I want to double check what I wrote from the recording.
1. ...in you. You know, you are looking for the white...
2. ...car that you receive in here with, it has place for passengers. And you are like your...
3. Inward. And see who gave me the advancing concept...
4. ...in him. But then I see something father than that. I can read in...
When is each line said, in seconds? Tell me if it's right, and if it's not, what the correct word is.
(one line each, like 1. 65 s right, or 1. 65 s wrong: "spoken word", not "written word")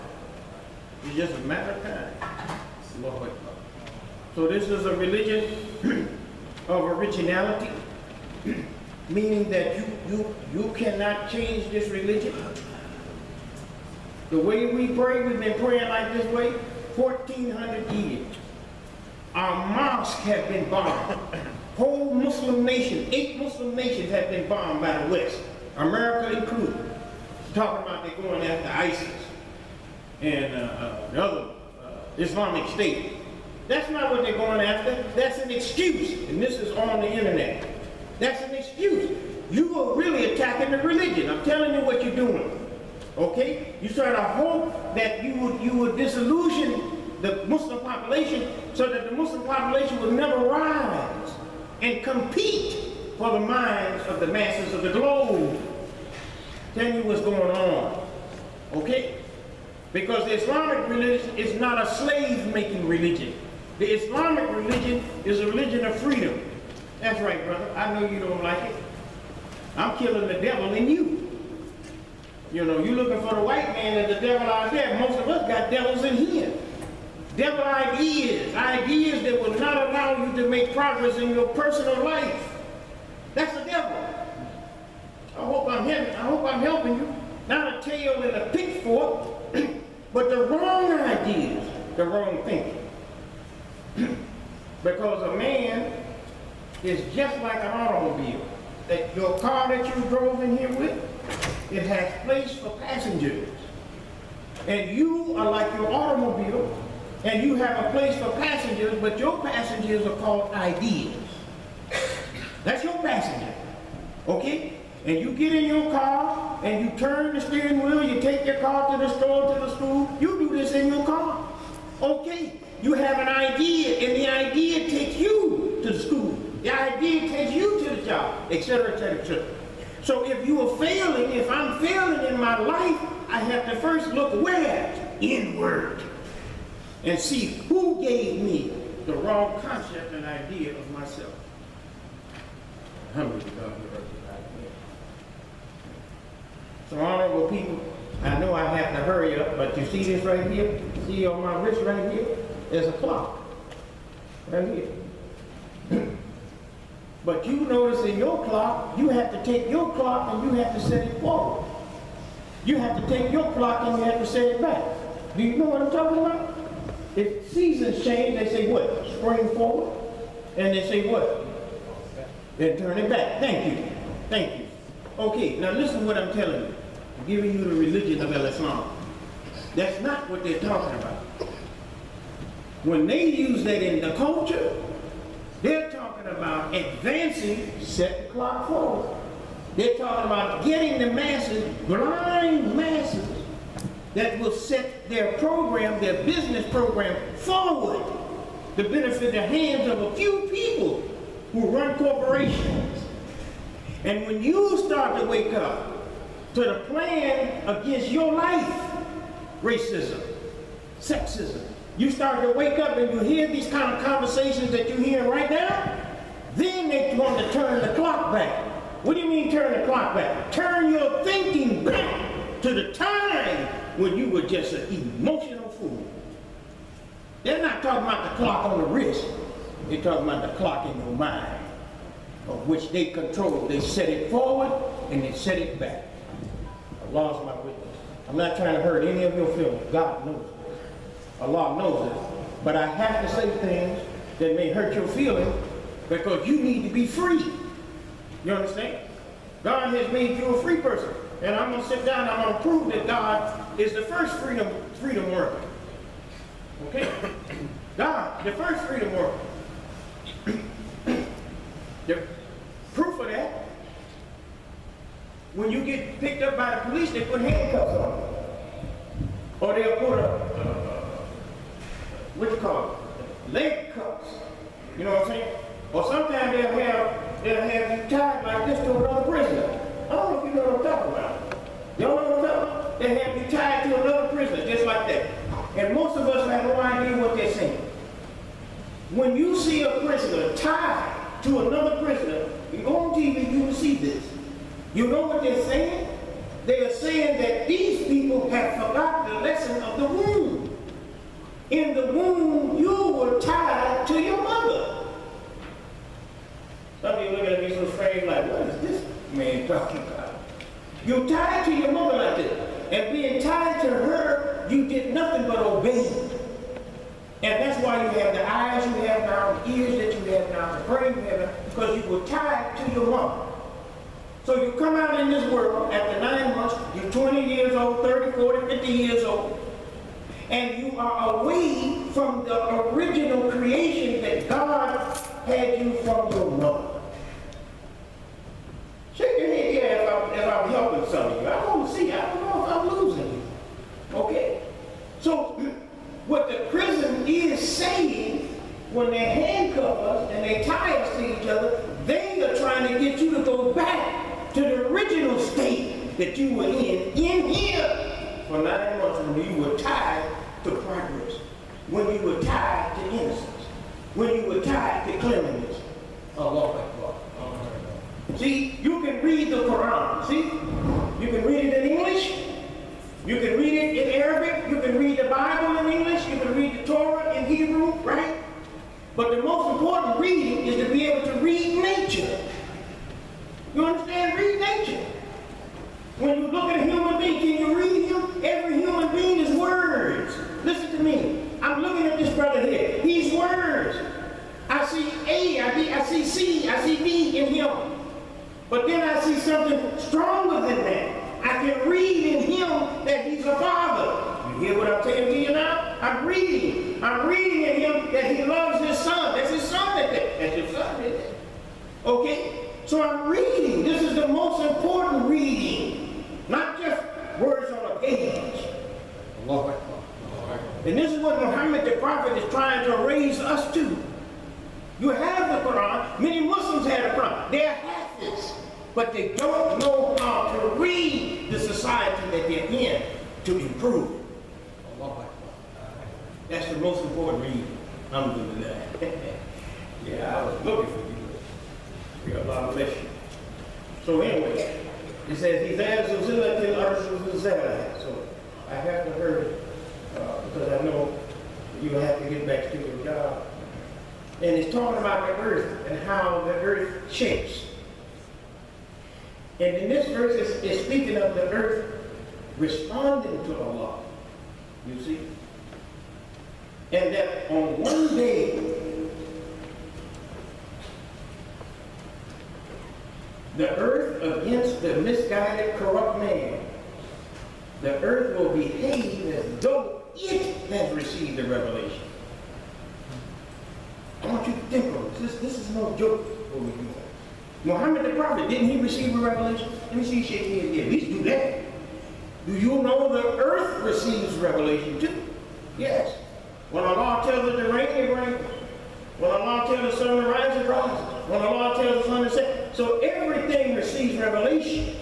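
1. 70 s right
2. 99 s wrong: "drove", not "receive"
3. 135 s wrong: "wrong", not "advancing"
4. 397 s wrong: "stronger", not "father".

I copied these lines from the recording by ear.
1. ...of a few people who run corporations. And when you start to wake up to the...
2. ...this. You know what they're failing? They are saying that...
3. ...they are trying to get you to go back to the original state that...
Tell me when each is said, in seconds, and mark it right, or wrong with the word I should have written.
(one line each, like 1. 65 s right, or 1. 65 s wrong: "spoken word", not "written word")
1. 199 s right
2. 293 s wrong: "saying", not "failing"
3. 352 s right.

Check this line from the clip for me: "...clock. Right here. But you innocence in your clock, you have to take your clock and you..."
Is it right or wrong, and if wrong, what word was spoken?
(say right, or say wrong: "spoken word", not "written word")
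wrong: "notice", not "innocence".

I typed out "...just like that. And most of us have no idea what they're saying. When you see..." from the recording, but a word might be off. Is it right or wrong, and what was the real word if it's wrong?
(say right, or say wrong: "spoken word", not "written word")
right.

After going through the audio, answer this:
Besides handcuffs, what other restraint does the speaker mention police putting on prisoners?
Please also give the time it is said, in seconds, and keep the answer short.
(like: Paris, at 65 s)
leg cuffs, at 273 s.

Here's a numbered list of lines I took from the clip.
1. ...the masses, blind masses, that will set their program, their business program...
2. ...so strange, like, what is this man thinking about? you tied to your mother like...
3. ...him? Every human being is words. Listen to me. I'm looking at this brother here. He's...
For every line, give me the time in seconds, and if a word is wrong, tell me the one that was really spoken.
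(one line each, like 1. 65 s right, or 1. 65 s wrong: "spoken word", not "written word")
1. 190 s right
2. 307 s wrong: "talking", not "thinking"
3. 388 s right.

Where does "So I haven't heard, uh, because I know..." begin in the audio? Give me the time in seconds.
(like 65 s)
448 s.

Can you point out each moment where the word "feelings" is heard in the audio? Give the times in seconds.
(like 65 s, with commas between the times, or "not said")
239 s, 245 s.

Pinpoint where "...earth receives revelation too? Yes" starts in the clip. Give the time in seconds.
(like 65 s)
493 s.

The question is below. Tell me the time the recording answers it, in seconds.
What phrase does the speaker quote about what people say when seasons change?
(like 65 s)
169 s.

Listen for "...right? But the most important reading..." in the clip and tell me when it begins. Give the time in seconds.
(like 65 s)
378 s.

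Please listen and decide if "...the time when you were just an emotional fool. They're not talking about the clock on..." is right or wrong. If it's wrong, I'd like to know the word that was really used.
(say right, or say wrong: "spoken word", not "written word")
right.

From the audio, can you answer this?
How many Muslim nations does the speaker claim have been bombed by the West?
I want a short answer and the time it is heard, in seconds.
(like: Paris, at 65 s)
8, at 23 s.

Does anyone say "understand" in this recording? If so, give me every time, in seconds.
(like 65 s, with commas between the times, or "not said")
248 s, 383 s.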